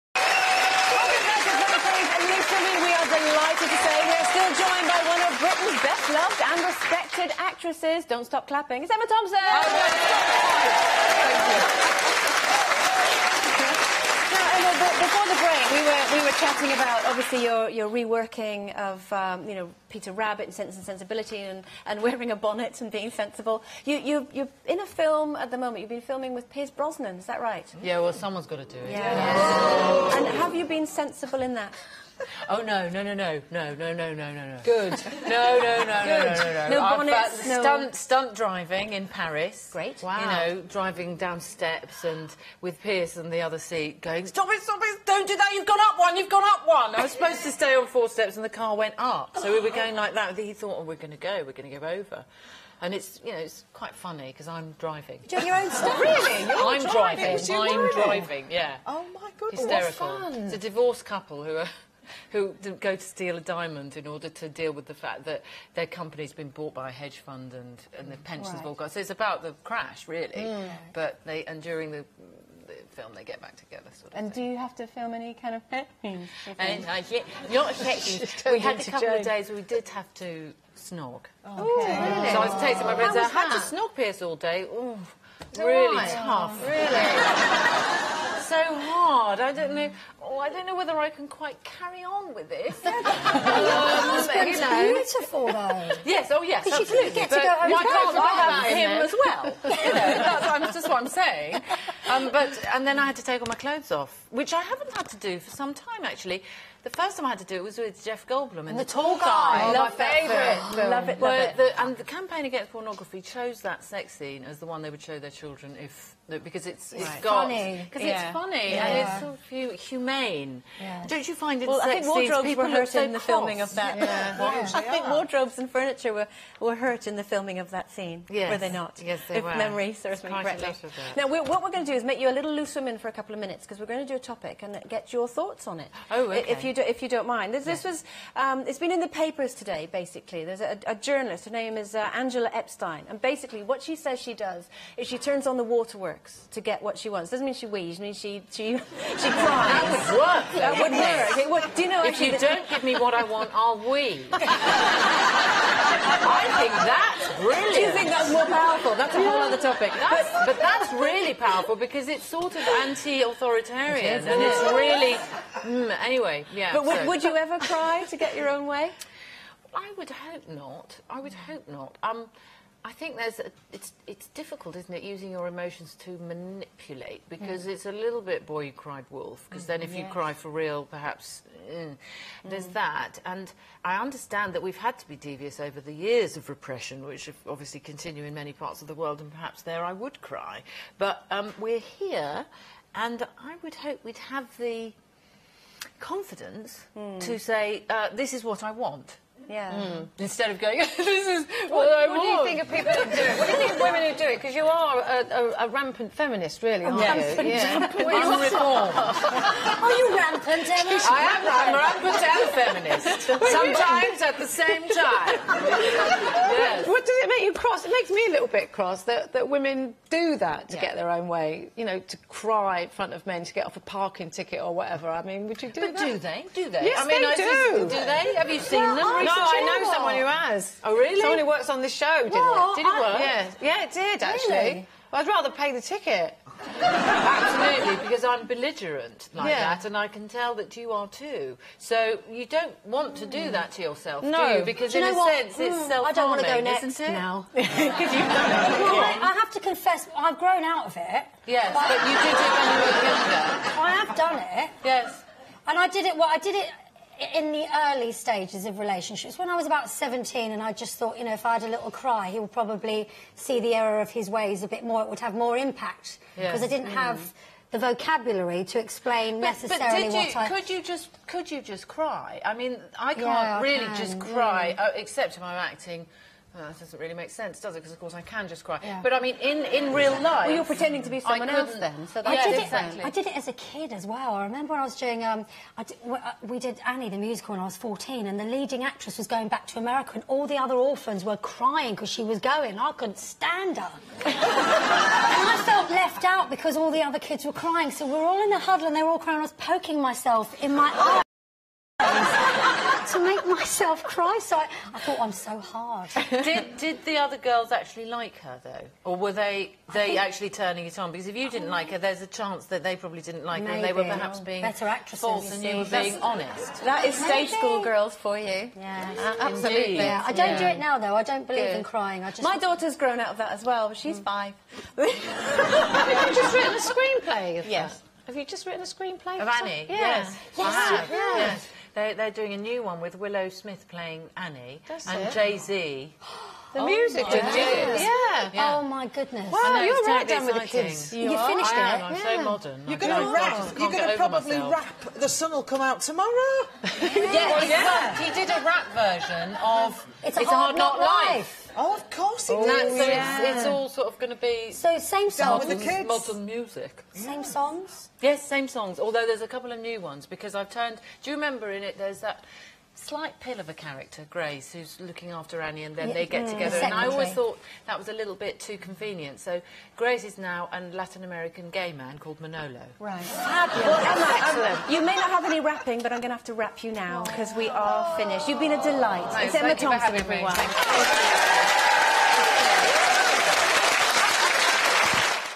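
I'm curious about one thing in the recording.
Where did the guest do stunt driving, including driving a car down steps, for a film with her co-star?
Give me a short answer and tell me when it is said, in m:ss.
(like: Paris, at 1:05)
Paris, at 0:39.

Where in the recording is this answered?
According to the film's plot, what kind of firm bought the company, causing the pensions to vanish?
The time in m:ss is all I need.
1:06.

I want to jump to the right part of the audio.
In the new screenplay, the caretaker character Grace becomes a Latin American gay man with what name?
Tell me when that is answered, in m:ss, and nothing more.
6:12.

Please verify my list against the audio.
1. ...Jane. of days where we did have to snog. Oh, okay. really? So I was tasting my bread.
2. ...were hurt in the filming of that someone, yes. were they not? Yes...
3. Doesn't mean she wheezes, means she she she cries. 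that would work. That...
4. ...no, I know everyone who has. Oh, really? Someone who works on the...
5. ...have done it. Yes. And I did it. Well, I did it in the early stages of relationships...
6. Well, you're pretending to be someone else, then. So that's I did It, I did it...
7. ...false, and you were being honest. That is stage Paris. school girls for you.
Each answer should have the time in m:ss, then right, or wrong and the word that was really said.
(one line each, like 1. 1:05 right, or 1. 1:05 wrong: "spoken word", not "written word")
1. 1:19 right
2. 2:06 wrong: "scene", not "someone"
3. 2:27 right
4. 3:49 wrong: "someone", not "everyone"
5. 4:14 right
6. 4:40 right
7. 5:15 wrong: "Maybe", not "Paris".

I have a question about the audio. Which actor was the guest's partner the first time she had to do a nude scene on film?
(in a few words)
Jeff Goldblum.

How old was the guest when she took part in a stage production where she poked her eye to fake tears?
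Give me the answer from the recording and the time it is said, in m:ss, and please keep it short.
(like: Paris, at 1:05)
14, at 4:47.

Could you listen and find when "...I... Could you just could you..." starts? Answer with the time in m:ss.
4:30.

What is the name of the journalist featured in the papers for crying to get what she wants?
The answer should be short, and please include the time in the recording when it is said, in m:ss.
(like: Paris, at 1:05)
Angela Epstein, at 2:22.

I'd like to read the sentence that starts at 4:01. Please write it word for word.
So you don't want to do that to yourself, no.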